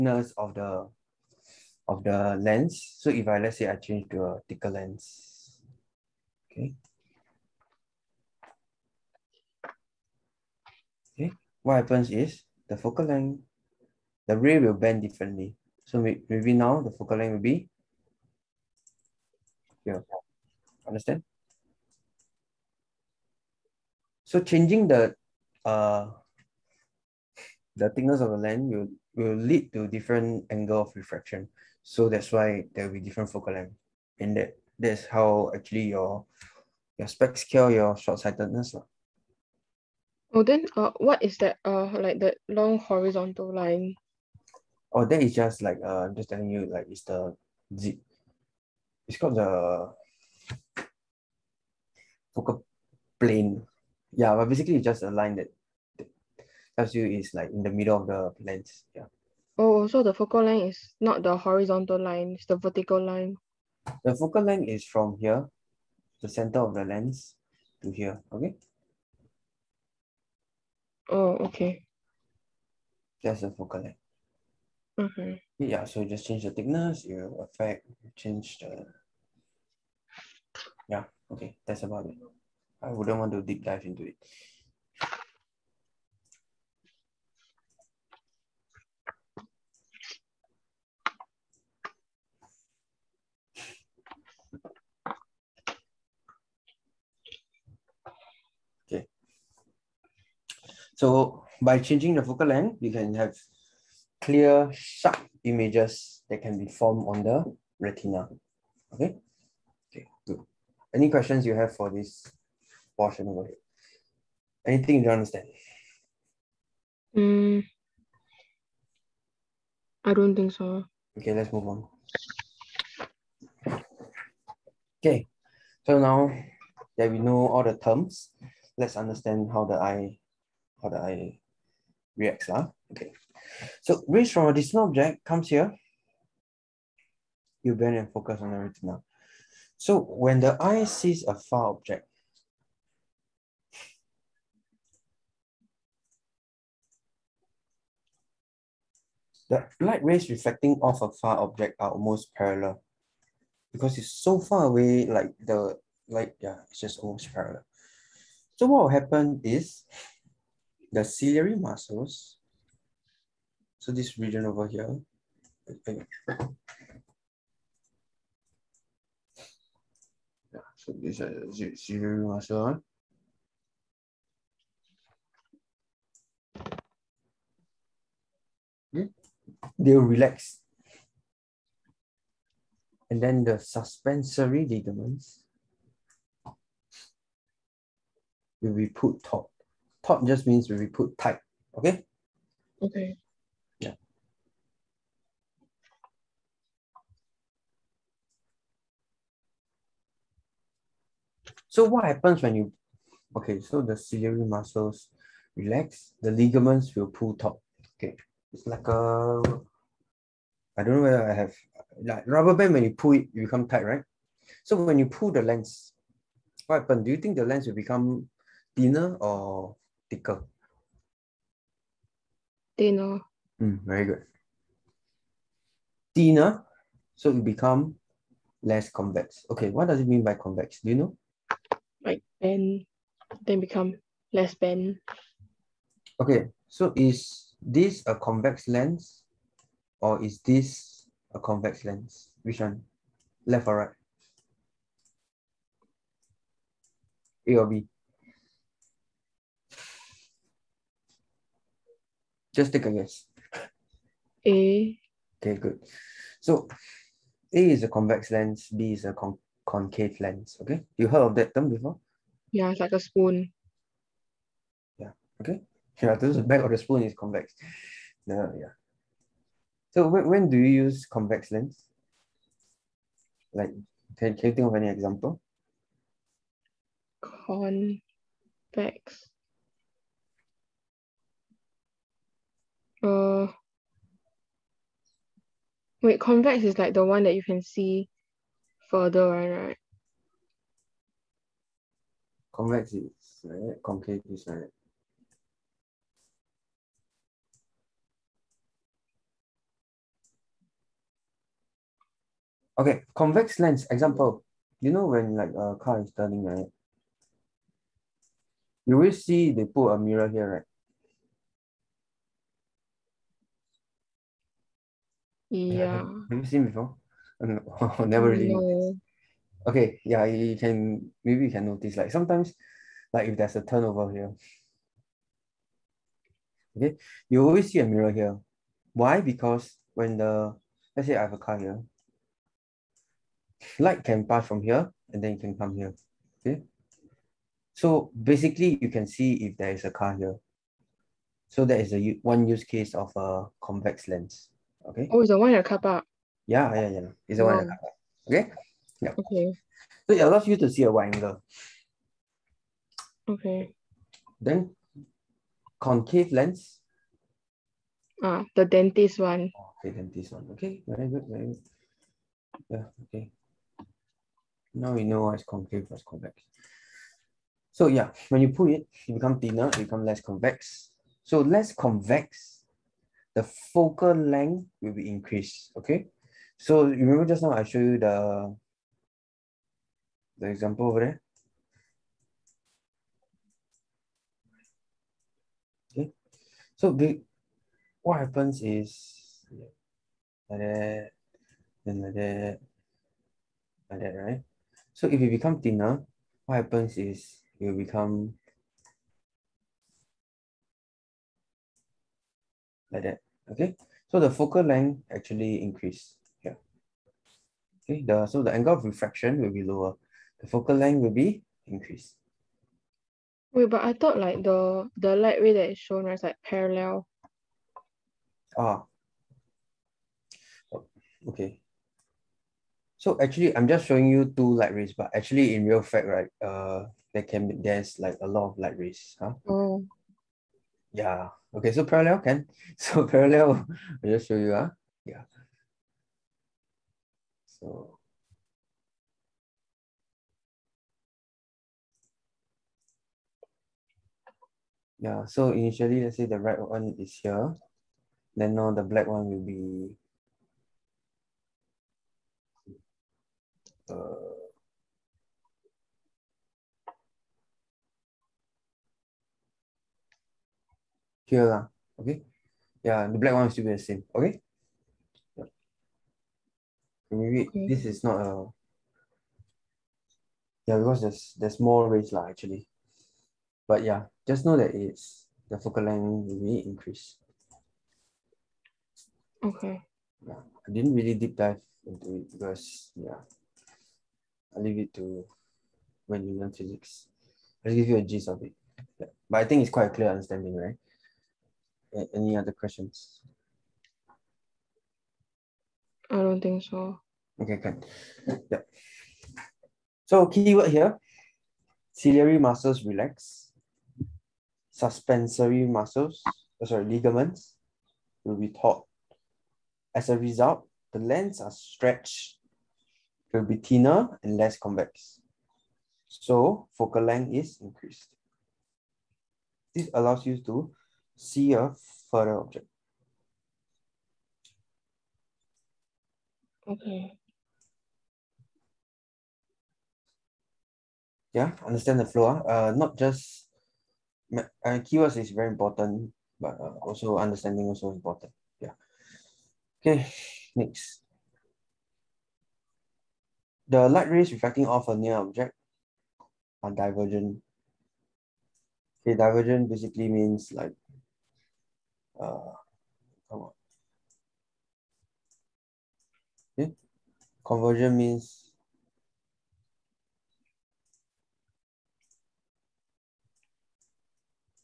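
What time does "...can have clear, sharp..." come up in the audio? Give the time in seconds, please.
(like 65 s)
102 s.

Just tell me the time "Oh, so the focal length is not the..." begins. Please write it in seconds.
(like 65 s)
59 s.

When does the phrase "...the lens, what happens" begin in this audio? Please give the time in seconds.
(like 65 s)
215 s.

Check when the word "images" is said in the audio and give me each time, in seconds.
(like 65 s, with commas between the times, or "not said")
105 s.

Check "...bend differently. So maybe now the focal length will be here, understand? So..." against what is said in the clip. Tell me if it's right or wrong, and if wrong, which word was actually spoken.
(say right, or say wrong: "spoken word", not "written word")
right.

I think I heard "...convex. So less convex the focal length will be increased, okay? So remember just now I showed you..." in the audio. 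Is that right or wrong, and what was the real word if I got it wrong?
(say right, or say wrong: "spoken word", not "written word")
right.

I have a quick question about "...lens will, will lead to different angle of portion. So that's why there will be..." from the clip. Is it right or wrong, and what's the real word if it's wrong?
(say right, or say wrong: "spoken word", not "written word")
wrong: "refraction", not "portion".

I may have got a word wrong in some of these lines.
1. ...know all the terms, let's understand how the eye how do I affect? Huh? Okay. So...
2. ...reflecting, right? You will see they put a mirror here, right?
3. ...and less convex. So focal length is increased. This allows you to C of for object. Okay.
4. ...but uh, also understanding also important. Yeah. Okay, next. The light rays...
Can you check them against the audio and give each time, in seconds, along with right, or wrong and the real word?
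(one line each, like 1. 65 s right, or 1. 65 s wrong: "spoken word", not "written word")
1. 127 s wrong: "react", not "affect"
2. 306 s wrong: "turning", not "reflecting"
3. 514 s right
4. 536 s right.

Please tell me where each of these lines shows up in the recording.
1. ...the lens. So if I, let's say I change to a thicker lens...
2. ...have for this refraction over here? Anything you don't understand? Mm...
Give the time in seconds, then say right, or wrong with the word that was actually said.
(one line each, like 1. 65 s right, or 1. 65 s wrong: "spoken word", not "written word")
1. 2 s right
2. 111 s wrong: "portion", not "refraction".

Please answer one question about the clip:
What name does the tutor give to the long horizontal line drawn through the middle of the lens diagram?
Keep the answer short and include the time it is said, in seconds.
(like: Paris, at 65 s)
focal plane, at 52 s.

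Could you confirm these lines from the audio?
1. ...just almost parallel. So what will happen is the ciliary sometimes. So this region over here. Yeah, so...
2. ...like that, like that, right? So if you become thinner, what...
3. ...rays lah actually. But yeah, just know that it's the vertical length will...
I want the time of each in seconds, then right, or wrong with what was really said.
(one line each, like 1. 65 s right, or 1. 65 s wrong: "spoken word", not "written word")
1. 156 s wrong: "muscles", not "sometimes"
2. 392 s right
3. 471 s wrong: "focal", not "vertical".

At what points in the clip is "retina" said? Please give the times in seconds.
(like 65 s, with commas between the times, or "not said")
107 s, 138 s.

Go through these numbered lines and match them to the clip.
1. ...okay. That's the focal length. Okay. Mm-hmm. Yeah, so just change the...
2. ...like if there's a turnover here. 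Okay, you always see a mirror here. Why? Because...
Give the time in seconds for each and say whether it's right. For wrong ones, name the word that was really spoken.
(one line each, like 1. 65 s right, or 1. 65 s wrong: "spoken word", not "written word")
1. 71 s right
2. 323 s right.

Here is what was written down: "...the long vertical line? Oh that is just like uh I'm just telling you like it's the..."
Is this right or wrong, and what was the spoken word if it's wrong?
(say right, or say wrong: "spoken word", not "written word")
wrong: "horizontal", not "vertical".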